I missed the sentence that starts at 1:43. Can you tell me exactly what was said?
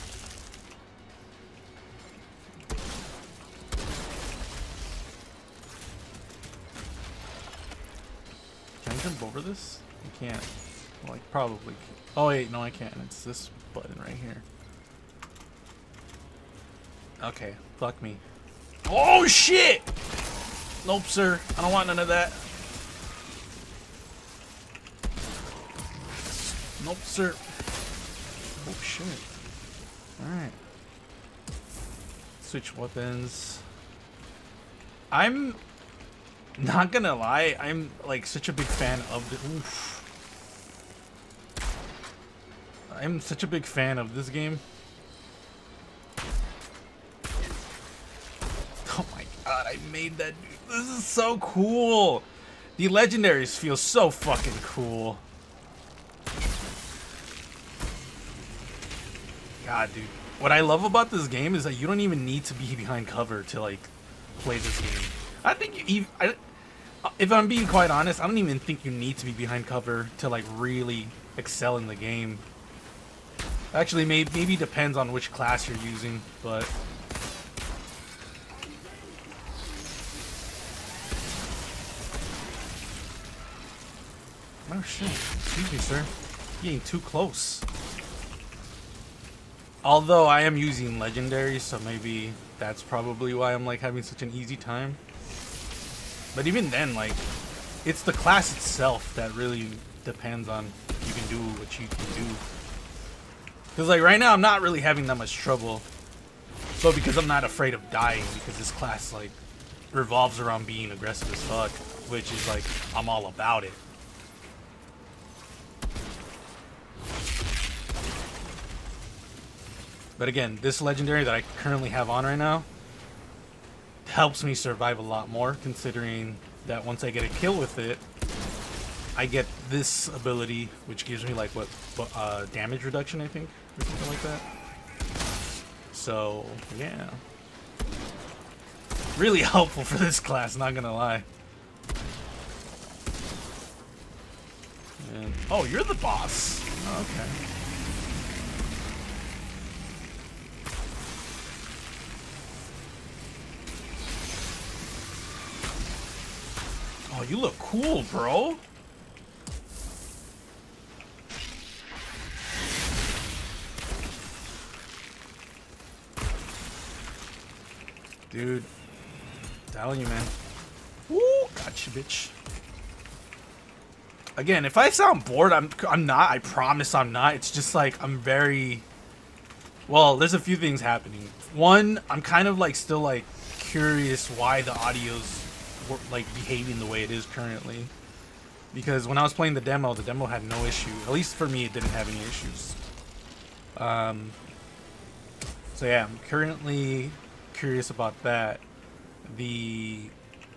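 Because like right now I'm not really having that much trouble.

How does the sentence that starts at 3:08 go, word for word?
Because when I was playing the demo, the demo had no issue.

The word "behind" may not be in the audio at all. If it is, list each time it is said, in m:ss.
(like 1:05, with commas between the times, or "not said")
1:02, 1:09.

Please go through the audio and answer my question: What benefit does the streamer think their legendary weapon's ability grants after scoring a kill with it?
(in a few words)
damage reduction.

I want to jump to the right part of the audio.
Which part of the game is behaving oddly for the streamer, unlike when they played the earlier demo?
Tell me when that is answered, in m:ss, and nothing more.
3:04.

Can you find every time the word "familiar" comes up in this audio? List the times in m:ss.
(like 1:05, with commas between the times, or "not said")
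not said.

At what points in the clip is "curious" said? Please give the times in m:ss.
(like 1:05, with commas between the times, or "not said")
3:03, 3:17.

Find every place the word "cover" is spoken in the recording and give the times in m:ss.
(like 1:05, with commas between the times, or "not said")
1:03, 1:09.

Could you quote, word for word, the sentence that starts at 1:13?
Actually, maybe maybe depends on which class you're using, but.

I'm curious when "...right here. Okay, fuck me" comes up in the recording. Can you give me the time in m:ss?
0:13.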